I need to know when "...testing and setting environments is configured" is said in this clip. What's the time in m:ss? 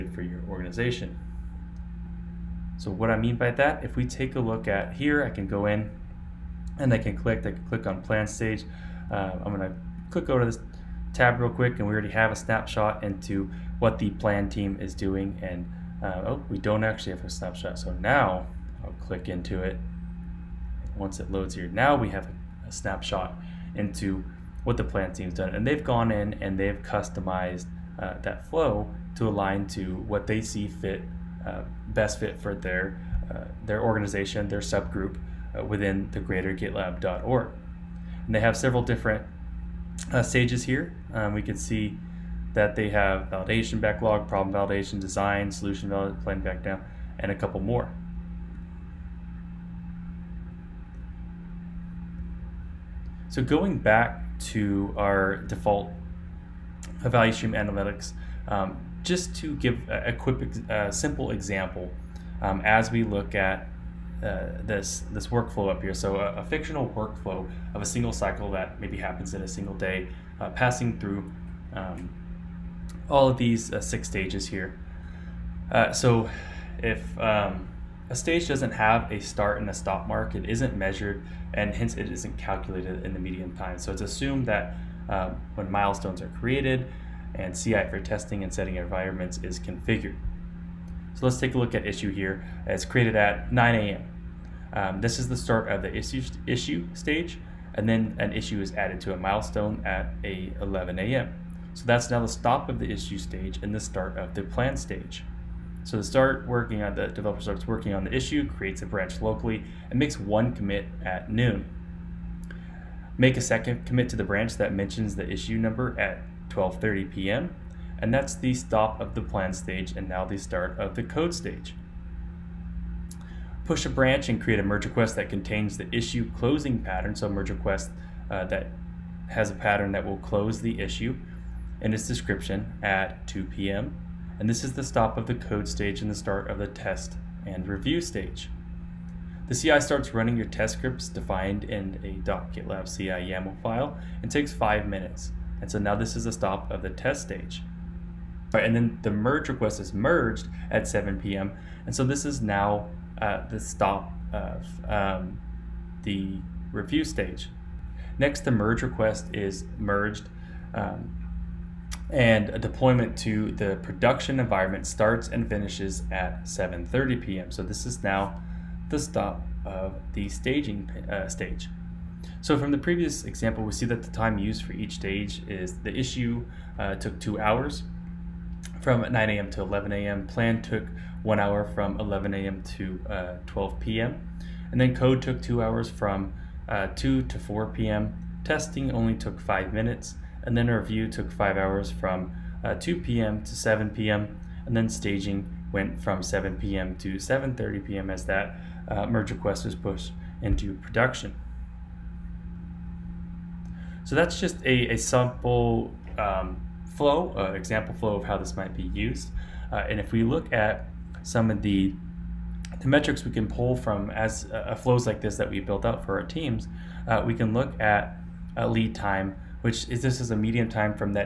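1:27.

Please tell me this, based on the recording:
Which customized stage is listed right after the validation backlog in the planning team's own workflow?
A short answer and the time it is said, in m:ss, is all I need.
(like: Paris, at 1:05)
problem validation, at 0:44.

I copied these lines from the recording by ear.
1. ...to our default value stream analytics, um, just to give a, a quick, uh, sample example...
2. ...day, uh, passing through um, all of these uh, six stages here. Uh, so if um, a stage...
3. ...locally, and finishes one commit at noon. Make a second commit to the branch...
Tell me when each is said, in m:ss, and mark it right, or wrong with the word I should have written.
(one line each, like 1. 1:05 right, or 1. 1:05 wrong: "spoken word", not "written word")
1. 0:54 wrong: "simple", not "sample"
2. 1:09 right
3. 1:49 wrong: "makes", not "finishes".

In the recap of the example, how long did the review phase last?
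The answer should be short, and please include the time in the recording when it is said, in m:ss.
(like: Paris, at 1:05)
five hours, at 3:11.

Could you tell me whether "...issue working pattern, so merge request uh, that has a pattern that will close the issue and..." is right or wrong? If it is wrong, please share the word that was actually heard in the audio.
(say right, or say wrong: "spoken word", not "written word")
wrong: "closing", not "working".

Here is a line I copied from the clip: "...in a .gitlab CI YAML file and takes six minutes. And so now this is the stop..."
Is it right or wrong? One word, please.
wrong.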